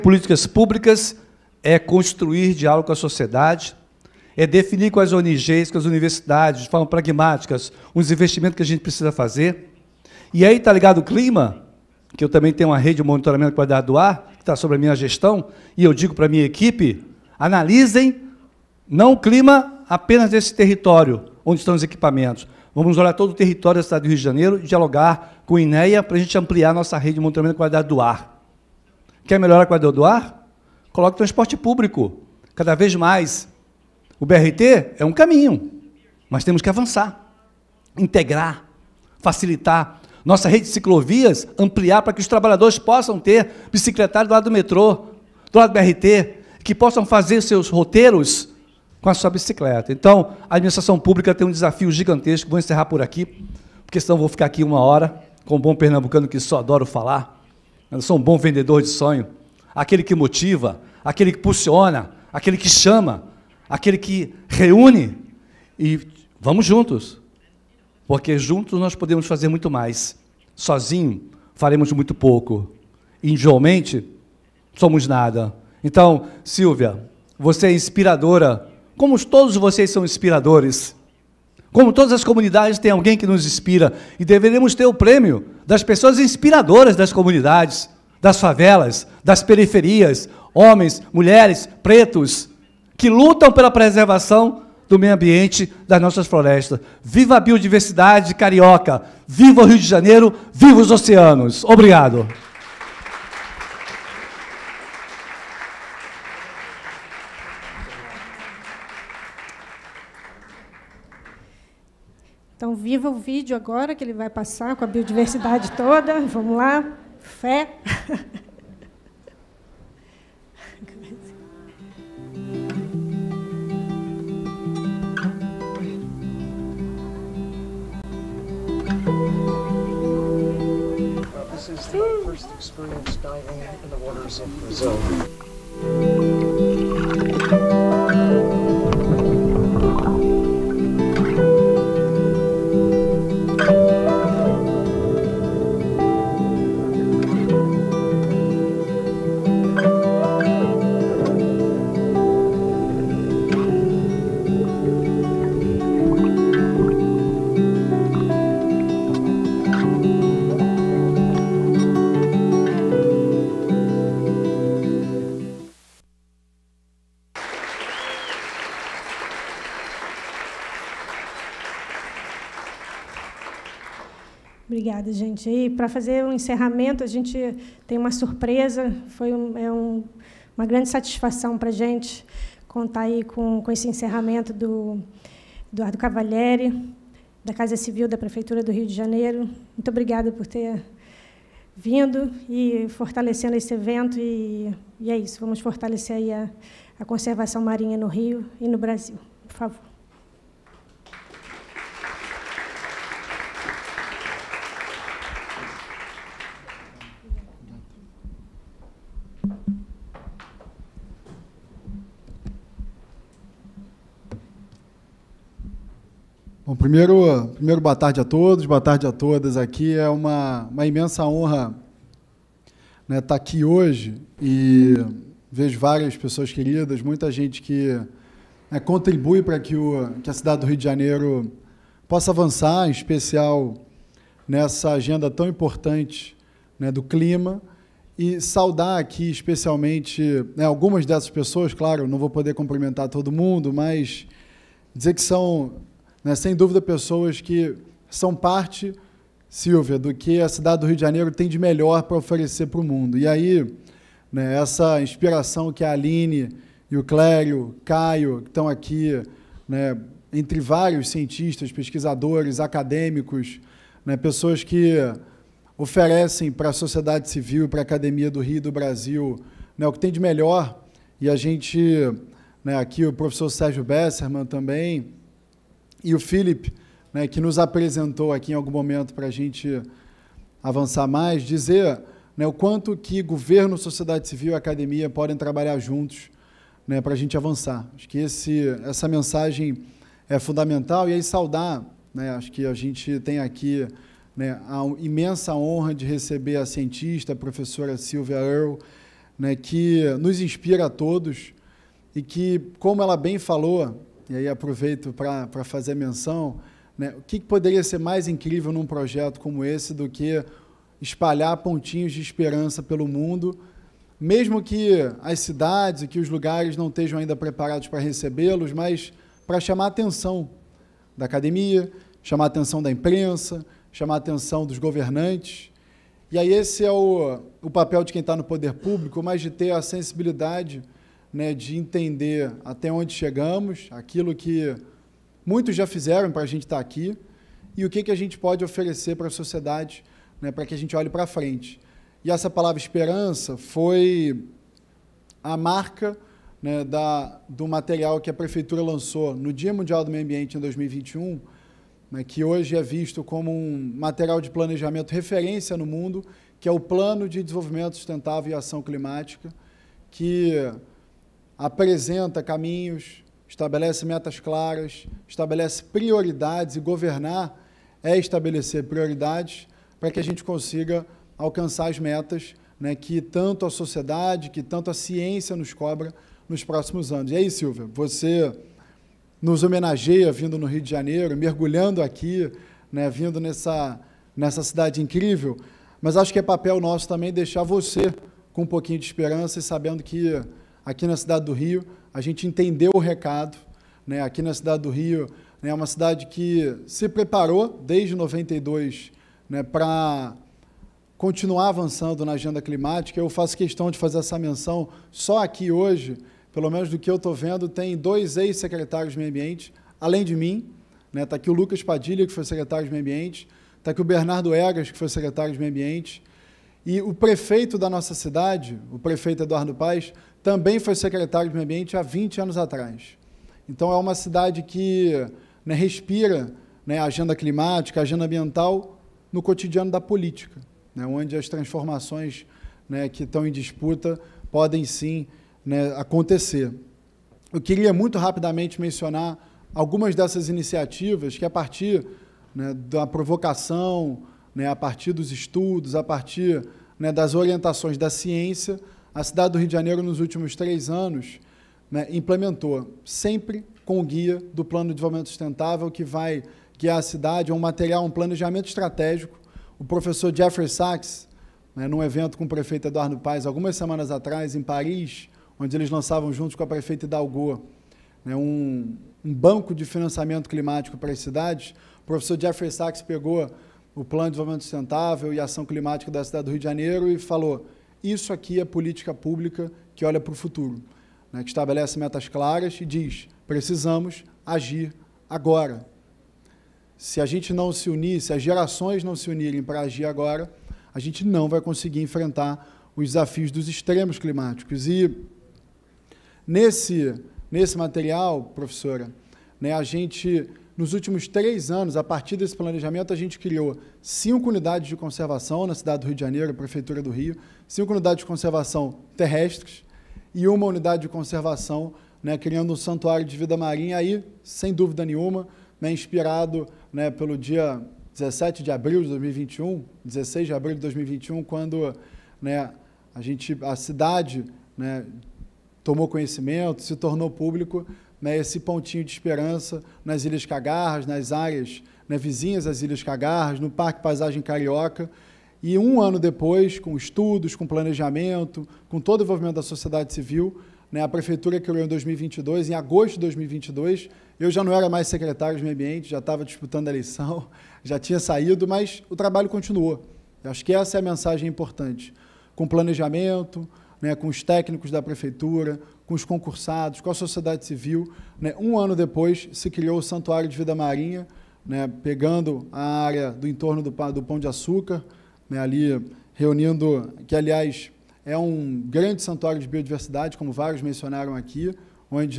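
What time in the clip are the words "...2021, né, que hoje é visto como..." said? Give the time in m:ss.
5:50.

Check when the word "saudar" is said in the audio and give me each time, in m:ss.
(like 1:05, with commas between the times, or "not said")
3:58, 4:51.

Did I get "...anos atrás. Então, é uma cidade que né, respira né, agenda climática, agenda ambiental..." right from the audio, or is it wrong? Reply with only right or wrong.
right.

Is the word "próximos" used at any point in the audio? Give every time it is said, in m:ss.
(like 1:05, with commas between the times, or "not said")
6:16.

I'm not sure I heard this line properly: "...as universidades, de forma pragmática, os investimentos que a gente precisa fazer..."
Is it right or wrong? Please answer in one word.
right.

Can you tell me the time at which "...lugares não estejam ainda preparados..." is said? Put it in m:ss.
5:16.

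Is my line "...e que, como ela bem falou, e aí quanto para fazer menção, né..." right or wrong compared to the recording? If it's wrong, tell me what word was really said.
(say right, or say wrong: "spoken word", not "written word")
wrong: "aproveito", not "quanto".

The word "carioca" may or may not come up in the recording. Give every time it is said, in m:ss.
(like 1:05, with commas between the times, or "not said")
1:38, 8:54.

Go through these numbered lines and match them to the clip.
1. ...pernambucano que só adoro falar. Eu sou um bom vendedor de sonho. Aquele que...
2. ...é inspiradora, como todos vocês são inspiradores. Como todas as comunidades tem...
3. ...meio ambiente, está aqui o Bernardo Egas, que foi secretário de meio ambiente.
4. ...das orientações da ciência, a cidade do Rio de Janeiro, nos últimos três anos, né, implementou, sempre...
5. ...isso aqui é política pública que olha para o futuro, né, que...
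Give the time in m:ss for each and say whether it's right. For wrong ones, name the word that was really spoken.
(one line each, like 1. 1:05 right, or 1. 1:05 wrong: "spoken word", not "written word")
1. 0:55 right
2. 1:17 right
3. 6:52 right
4. 7:27 right
5. 7:58 right.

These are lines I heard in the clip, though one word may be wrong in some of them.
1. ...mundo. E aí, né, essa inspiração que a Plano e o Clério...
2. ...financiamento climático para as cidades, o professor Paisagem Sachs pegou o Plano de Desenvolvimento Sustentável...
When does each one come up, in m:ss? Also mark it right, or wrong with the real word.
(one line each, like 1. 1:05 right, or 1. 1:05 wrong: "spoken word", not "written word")
1. 4:12 wrong: "Aline", not "Plano"
2. 7:49 wrong: "Jeffrey", not "Paisagem".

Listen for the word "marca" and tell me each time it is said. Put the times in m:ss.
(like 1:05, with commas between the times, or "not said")
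5:45.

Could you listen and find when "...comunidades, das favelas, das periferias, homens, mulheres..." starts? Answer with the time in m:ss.
1:27.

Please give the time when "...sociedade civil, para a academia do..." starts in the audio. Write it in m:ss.
4:26.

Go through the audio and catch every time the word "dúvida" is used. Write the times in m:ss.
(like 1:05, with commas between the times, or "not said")
4:06, 8:34.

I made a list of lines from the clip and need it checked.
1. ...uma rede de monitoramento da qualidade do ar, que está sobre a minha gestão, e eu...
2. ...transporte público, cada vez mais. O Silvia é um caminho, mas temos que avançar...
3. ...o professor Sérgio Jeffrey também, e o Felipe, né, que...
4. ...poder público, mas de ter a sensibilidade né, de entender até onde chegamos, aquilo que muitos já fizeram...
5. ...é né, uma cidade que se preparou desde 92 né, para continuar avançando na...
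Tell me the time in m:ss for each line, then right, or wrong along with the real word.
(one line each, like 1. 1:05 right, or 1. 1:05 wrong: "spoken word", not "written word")
1. 0:12 right
2. 0:31 wrong: "BRT", not "Silvia"
3. 4:33 wrong: "Besserman", not "Jeffrey"
4. 5:28 right
5. 6:35 right.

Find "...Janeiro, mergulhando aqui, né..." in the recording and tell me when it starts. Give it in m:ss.
6:20.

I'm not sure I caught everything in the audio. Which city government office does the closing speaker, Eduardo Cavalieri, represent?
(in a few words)
Casa Civil.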